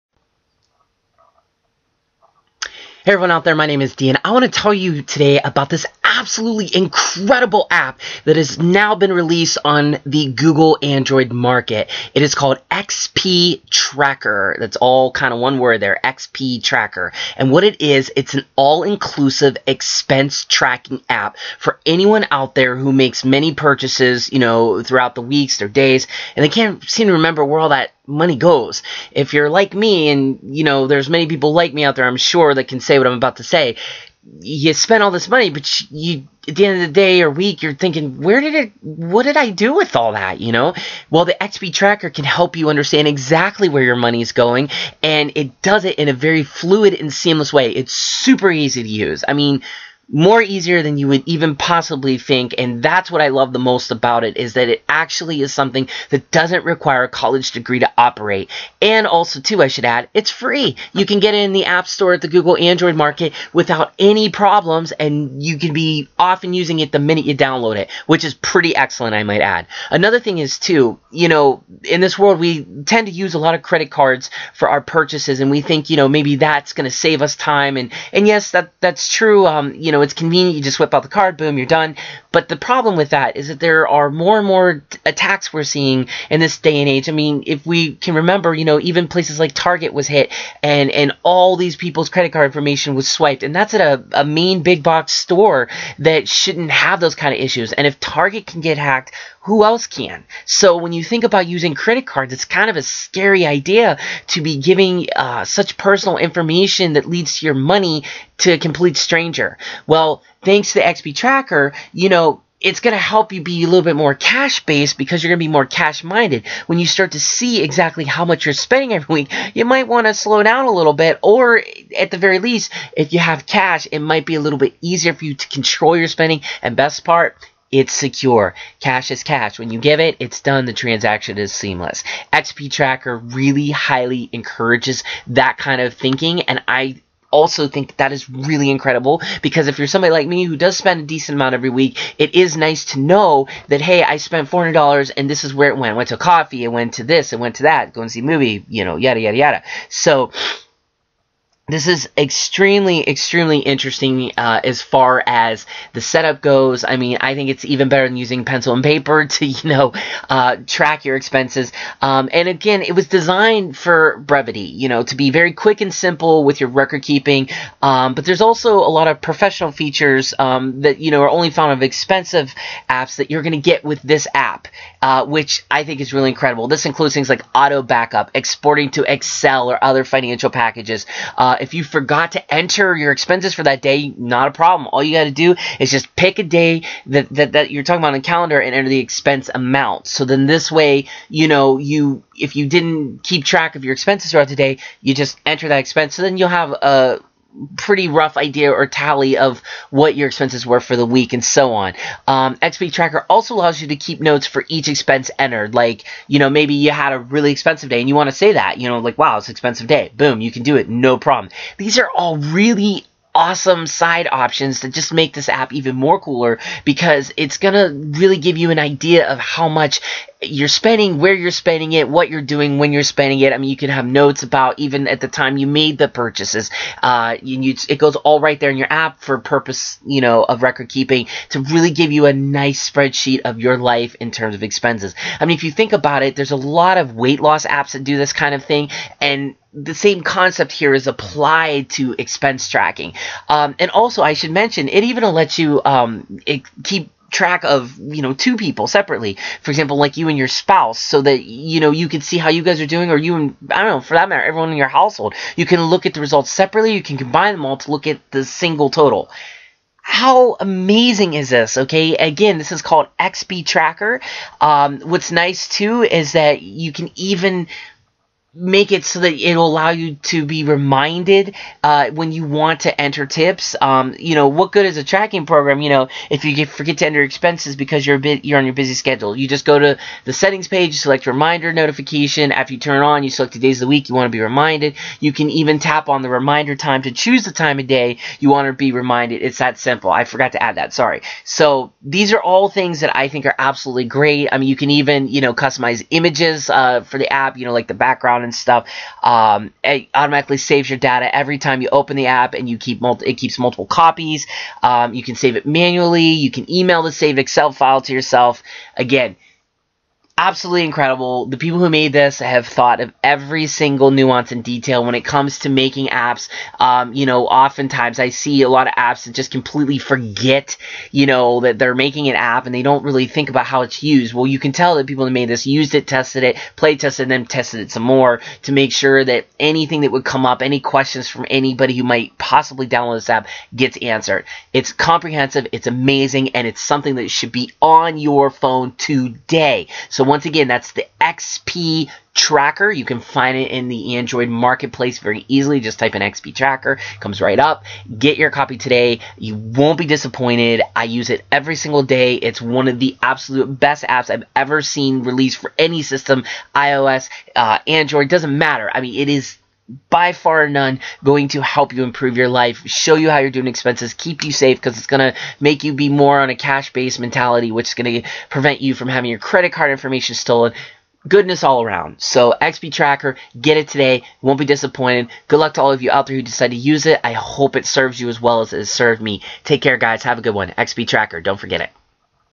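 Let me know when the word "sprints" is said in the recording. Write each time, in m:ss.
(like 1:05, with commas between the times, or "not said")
not said.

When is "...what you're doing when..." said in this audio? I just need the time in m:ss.
3:42.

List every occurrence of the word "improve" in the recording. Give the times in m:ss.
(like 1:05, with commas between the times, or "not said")
6:02.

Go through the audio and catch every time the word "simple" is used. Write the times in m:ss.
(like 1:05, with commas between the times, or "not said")
2:45, 4:49.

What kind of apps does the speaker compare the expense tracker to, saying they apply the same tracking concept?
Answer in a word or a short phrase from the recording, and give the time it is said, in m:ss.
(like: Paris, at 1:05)
weight loss apps, at 3:57.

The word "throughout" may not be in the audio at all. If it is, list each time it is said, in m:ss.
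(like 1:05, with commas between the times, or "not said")
0:24, 3:14.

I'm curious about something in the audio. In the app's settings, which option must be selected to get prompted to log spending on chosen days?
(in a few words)
reminder notification.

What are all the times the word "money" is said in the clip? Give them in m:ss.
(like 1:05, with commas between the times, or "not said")
0:28, 0:35, 0:43, 1:47.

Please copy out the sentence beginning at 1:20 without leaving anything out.
You just whip out the card, boom, you're done.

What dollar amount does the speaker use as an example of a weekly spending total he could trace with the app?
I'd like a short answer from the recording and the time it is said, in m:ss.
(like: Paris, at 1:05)
$400, at 2:24.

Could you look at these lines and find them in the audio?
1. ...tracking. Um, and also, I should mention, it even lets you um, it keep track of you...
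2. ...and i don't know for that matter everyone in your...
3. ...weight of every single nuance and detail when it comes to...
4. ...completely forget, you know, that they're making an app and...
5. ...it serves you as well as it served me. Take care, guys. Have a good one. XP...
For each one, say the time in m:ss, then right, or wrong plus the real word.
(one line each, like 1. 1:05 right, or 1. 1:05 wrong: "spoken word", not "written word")
1. 4:02 right
2. 4:13 right
3. 5:12 wrong: "thought", not "weight"
4. 5:19 right
5. 6:17 right.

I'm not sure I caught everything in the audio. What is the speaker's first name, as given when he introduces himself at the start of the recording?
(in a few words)
Dean.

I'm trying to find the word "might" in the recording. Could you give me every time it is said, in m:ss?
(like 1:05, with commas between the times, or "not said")
1:09, 1:59, 2:03, 5:32.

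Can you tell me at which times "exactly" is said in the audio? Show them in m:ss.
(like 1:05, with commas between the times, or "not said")
0:43, 1:57.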